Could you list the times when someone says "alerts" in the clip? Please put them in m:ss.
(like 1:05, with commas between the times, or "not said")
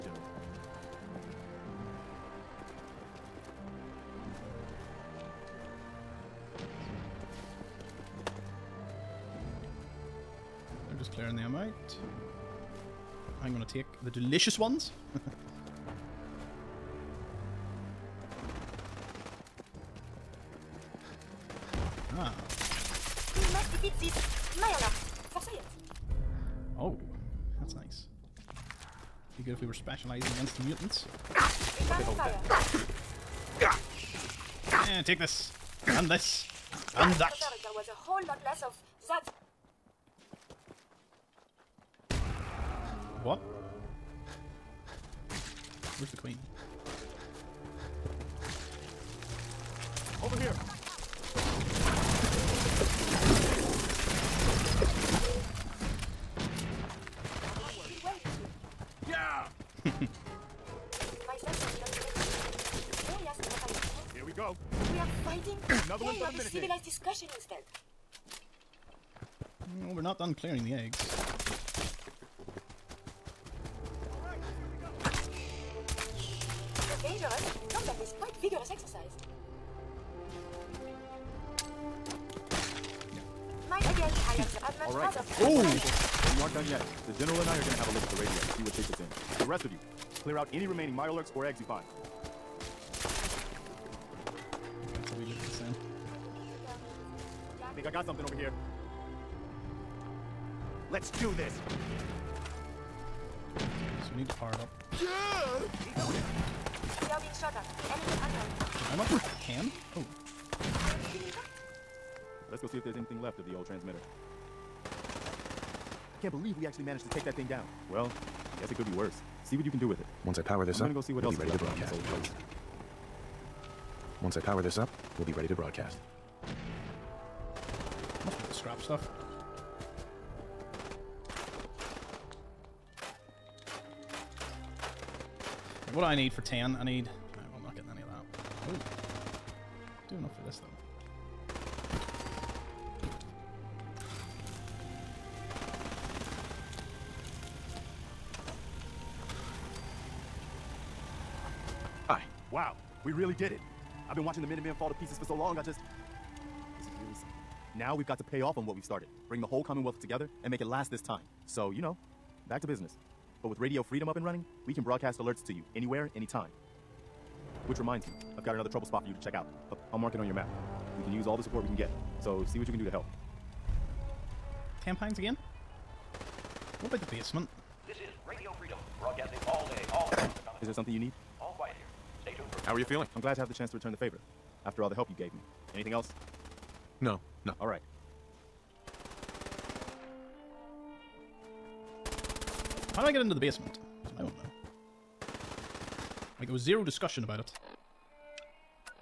2:45.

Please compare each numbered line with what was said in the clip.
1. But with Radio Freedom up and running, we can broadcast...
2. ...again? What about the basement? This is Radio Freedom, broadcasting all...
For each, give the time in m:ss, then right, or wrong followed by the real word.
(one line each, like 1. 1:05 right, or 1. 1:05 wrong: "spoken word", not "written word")
1. 2:43 right
2. 2:55 right.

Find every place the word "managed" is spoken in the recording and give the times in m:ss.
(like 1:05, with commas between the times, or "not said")
1:56.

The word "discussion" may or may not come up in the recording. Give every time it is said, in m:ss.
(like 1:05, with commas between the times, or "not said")
1:06, 3:16.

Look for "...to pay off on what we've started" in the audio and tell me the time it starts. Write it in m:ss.
2:38.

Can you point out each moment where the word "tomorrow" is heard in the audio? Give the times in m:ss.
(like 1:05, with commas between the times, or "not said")
not said.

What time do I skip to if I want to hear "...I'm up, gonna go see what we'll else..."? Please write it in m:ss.
2:00.